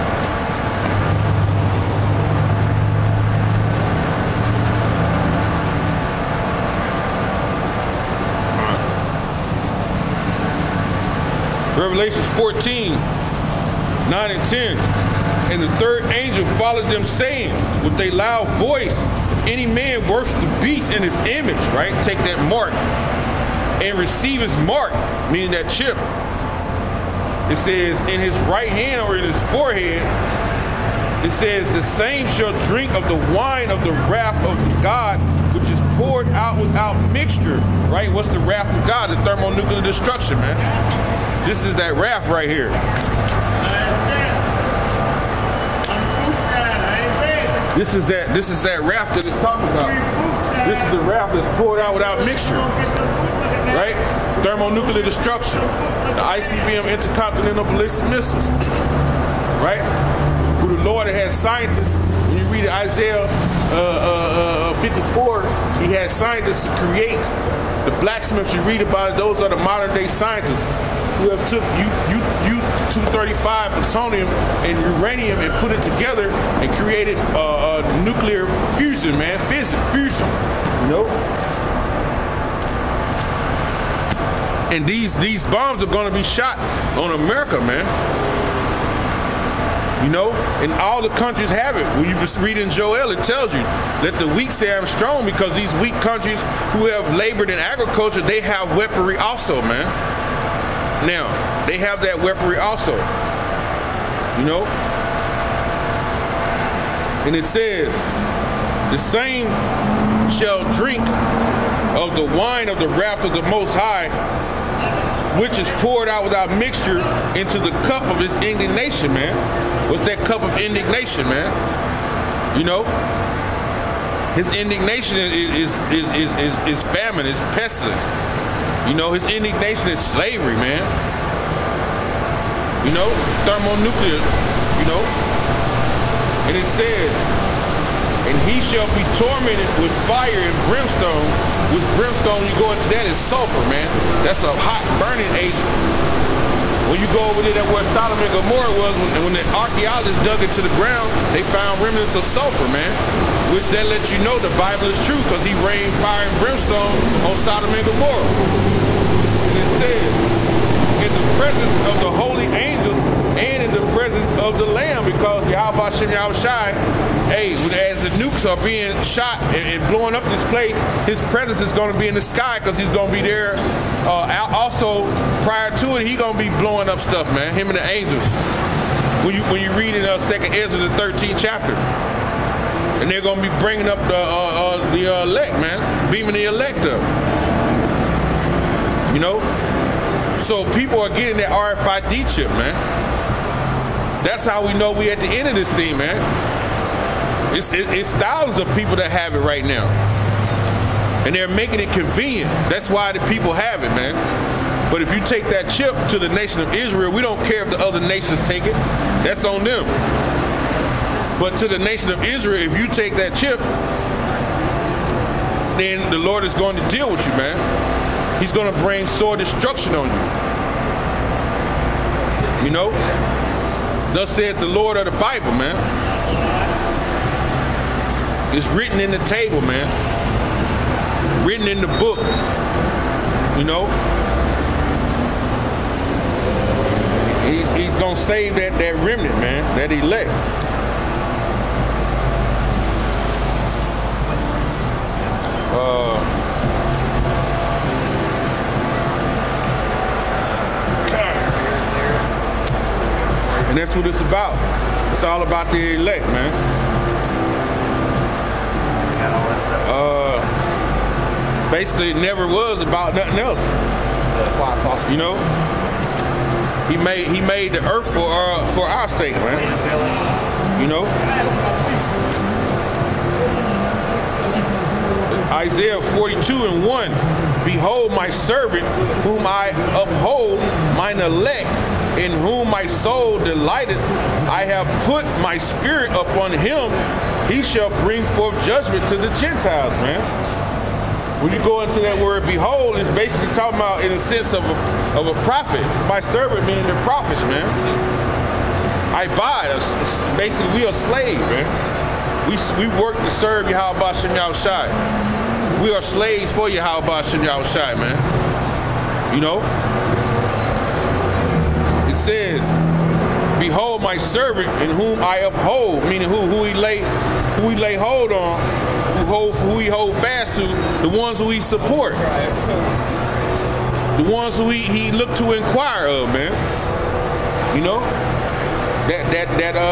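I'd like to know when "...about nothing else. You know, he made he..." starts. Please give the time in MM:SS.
04:22.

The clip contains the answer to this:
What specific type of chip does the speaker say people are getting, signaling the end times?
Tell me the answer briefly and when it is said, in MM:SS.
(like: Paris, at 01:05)
RFID chip, at 03:11.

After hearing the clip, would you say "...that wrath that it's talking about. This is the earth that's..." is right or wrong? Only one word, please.
wrong.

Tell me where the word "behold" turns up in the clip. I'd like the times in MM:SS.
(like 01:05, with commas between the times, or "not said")
04:37, 04:52, 05:13.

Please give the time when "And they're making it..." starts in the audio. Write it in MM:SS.
03:21.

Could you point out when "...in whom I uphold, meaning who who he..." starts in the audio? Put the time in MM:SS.
05:14.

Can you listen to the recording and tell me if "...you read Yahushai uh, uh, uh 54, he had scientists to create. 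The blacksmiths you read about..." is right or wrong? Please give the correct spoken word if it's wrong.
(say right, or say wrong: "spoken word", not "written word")
wrong: "Isaiah", not "Yahushai".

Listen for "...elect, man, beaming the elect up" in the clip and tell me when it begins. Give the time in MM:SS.
03:05.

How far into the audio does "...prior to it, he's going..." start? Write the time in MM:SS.
02:55.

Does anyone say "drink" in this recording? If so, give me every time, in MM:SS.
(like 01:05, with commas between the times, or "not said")
00:32, 01:50.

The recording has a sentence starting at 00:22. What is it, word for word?
Take that mark and receive his mark, meaning that chip.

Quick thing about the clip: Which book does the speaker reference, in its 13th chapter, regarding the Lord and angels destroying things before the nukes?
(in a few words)
2nd Ezra.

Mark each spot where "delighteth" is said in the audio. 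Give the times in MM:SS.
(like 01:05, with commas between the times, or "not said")
04:43.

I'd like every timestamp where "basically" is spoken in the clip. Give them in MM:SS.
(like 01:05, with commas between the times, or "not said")
04:21, 04:53, 05:00.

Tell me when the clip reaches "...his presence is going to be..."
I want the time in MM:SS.
02:51.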